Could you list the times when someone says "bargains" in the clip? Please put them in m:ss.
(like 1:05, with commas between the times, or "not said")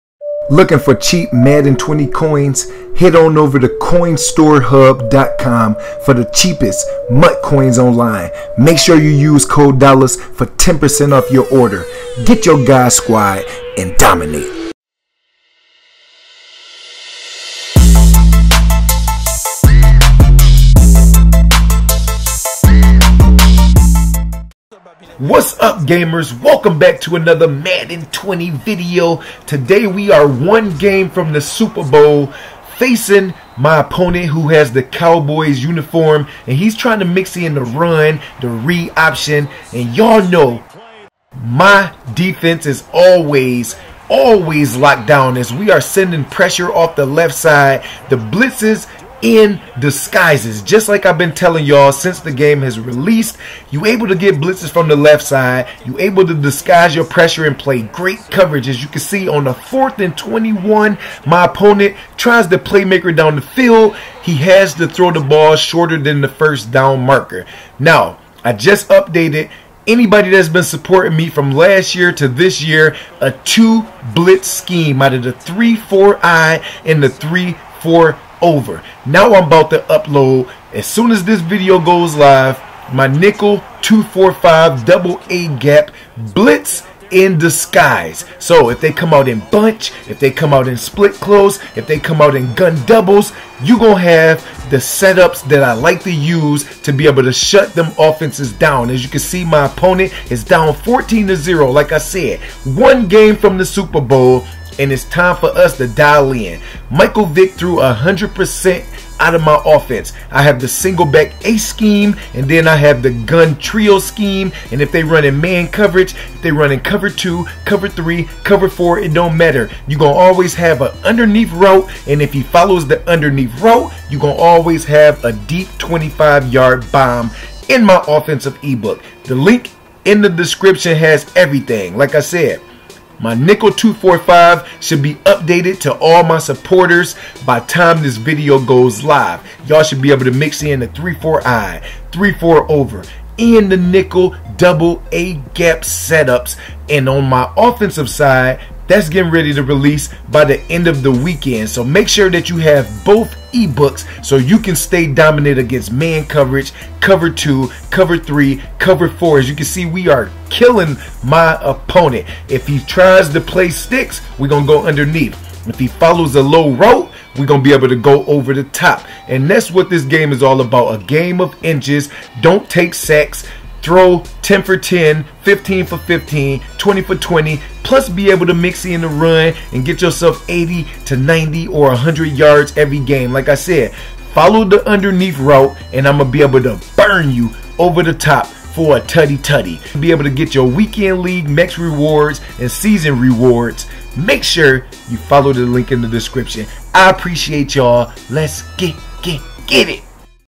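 not said.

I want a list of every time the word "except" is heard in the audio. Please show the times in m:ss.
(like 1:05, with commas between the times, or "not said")
not said.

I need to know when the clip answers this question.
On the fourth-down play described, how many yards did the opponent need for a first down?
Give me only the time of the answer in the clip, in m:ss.
0:59.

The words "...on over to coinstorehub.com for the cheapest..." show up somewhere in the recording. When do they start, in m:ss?
0:03.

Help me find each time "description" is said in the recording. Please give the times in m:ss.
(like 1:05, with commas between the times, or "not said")
2:10, 3:16.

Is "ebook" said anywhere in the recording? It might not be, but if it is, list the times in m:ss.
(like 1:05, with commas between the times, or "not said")
2:08, 2:33.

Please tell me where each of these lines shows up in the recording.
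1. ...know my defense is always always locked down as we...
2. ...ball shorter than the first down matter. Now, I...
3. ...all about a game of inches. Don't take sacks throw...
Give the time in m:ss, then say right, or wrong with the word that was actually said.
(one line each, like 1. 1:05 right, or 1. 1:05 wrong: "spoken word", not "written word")
1. 0:40 right
2. 1:05 wrong: "marker", not "matter"
3. 2:50 right.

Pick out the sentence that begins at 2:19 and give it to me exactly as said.
Y'all should be able to mix in the 3-4 I, 3-4 over, and the nickel double A gap setups.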